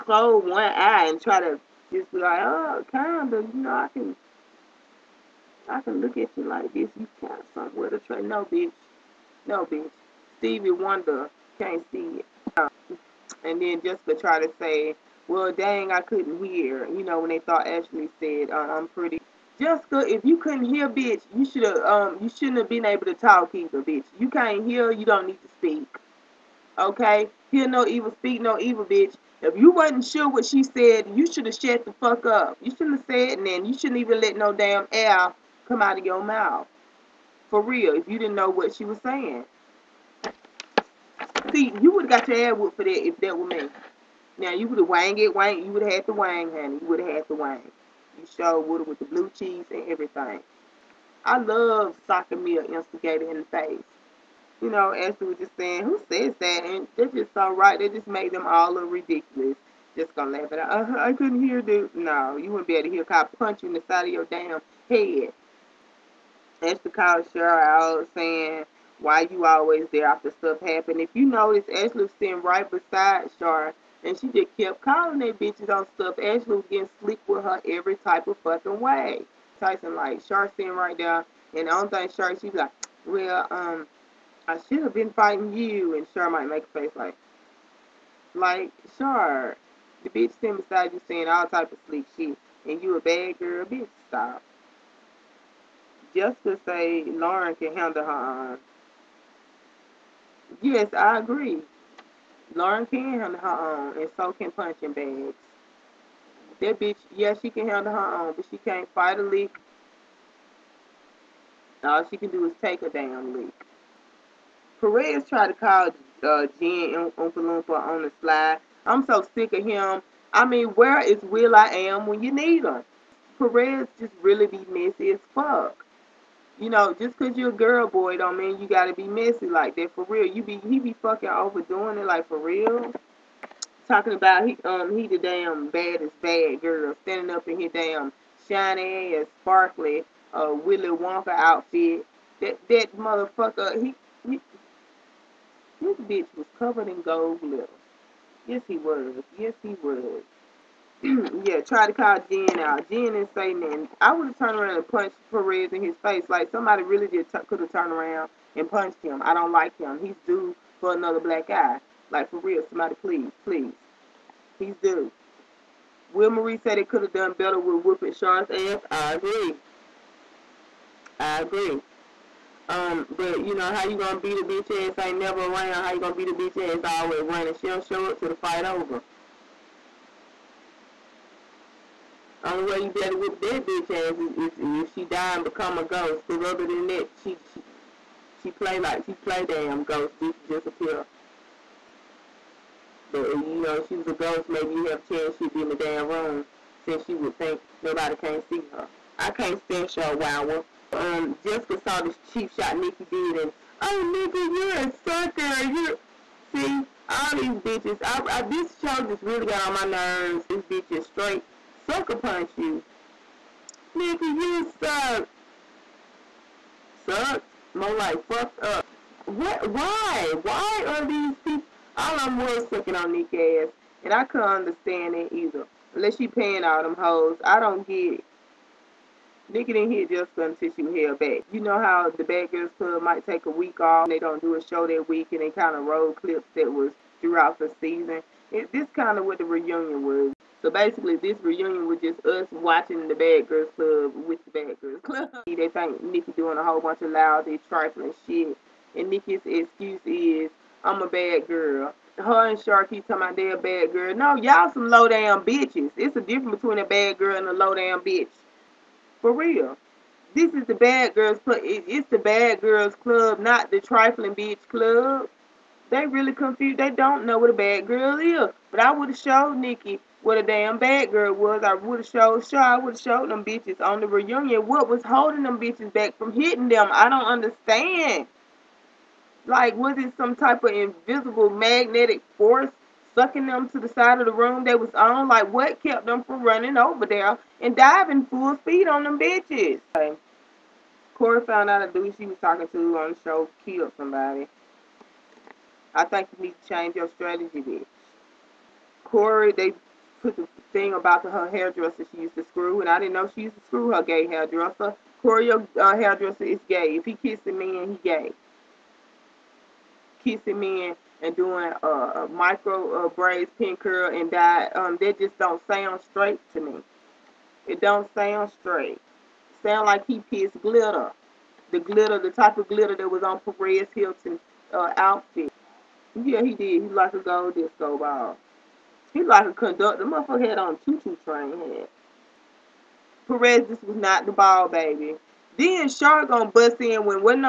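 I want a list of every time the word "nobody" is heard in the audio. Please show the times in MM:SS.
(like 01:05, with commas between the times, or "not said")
03:17.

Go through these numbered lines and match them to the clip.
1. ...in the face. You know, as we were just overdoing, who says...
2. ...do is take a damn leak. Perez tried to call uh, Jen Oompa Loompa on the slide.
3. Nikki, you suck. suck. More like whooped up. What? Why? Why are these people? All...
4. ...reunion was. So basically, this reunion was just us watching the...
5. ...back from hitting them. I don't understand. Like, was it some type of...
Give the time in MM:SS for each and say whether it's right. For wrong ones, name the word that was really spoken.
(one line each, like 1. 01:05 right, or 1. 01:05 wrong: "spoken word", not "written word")
1. 00:53 wrong: "saying", not "overdoing"
2. 01:52 right
3. 03:33 wrong: "fucked", not "whooped"
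4. 03:59 right
5. 04:35 right.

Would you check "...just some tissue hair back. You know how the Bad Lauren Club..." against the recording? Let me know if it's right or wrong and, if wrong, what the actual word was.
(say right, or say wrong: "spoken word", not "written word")
wrong: "Girls", not "Lauren".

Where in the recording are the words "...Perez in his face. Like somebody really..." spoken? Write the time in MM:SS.
02:35.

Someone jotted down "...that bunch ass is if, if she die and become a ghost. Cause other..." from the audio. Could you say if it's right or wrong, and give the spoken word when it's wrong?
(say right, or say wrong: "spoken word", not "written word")
wrong: "bitch", not "bunch".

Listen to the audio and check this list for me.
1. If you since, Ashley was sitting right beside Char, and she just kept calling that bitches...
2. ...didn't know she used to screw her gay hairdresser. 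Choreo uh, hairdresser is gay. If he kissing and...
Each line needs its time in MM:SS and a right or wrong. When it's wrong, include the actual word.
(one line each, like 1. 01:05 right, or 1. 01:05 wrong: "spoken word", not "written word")
1. 01:11 wrong: "notice", not "since"
2. 05:02 right.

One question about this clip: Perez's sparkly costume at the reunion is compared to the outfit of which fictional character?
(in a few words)
Willy Wonka.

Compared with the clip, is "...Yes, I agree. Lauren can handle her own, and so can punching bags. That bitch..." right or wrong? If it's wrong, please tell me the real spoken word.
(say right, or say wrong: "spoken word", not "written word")
right.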